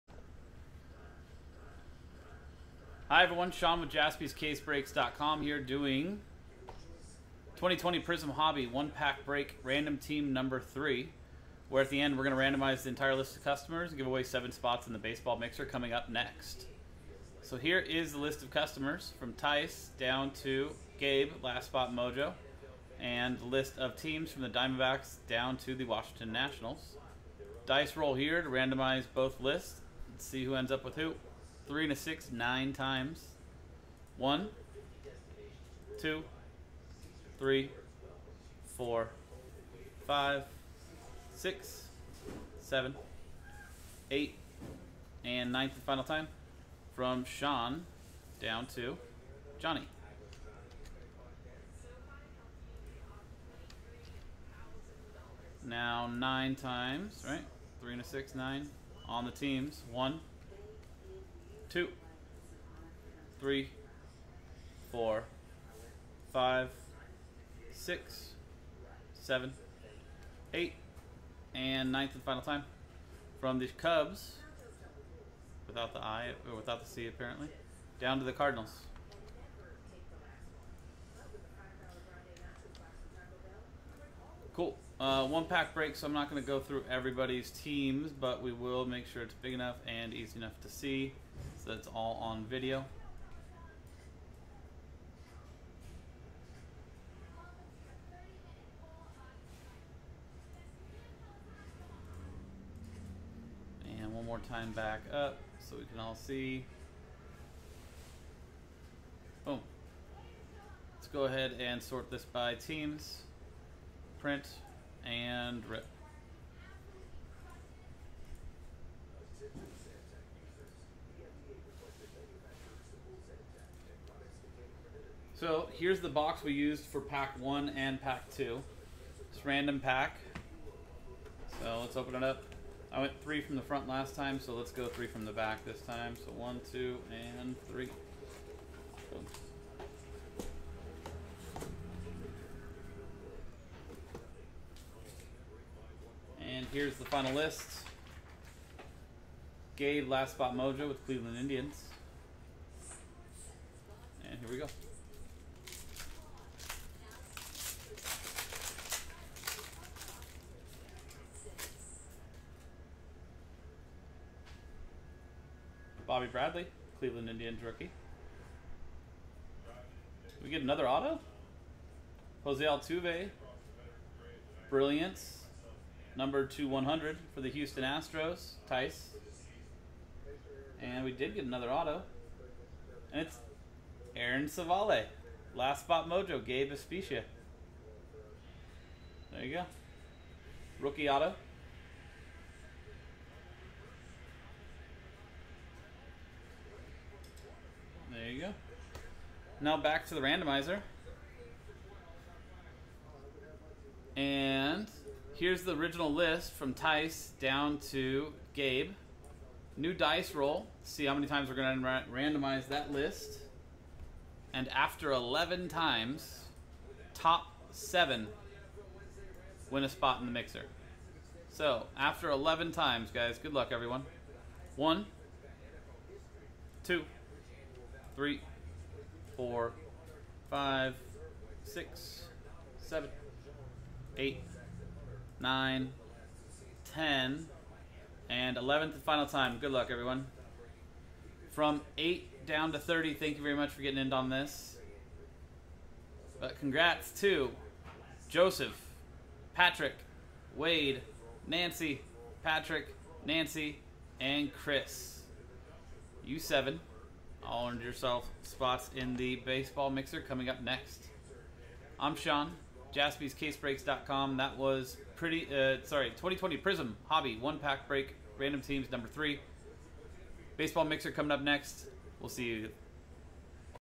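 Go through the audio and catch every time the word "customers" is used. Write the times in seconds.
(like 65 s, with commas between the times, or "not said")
13 s, 18 s.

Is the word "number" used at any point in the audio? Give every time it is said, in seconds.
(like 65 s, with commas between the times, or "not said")
10 s, 176 s, 268 s.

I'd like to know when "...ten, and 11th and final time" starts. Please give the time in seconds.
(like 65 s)
236 s.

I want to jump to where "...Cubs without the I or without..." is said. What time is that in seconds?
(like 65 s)
73 s.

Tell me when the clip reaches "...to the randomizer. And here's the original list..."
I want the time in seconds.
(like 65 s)
200 s.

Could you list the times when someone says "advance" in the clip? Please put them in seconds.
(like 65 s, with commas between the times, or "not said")
not said.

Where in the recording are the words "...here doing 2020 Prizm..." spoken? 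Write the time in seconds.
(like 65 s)
5 s.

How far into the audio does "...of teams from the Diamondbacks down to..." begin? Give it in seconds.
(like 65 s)
23 s.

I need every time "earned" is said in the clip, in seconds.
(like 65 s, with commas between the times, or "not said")
257 s.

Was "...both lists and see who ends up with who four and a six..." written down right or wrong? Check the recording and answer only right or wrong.
wrong.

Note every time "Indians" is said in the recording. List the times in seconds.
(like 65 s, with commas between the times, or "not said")
151 s, 167 s.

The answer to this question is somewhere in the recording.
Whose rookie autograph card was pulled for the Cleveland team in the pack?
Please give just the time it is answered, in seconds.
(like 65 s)
184 s.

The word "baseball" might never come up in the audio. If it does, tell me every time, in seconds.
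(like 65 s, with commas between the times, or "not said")
14 s, 259 s, 270 s.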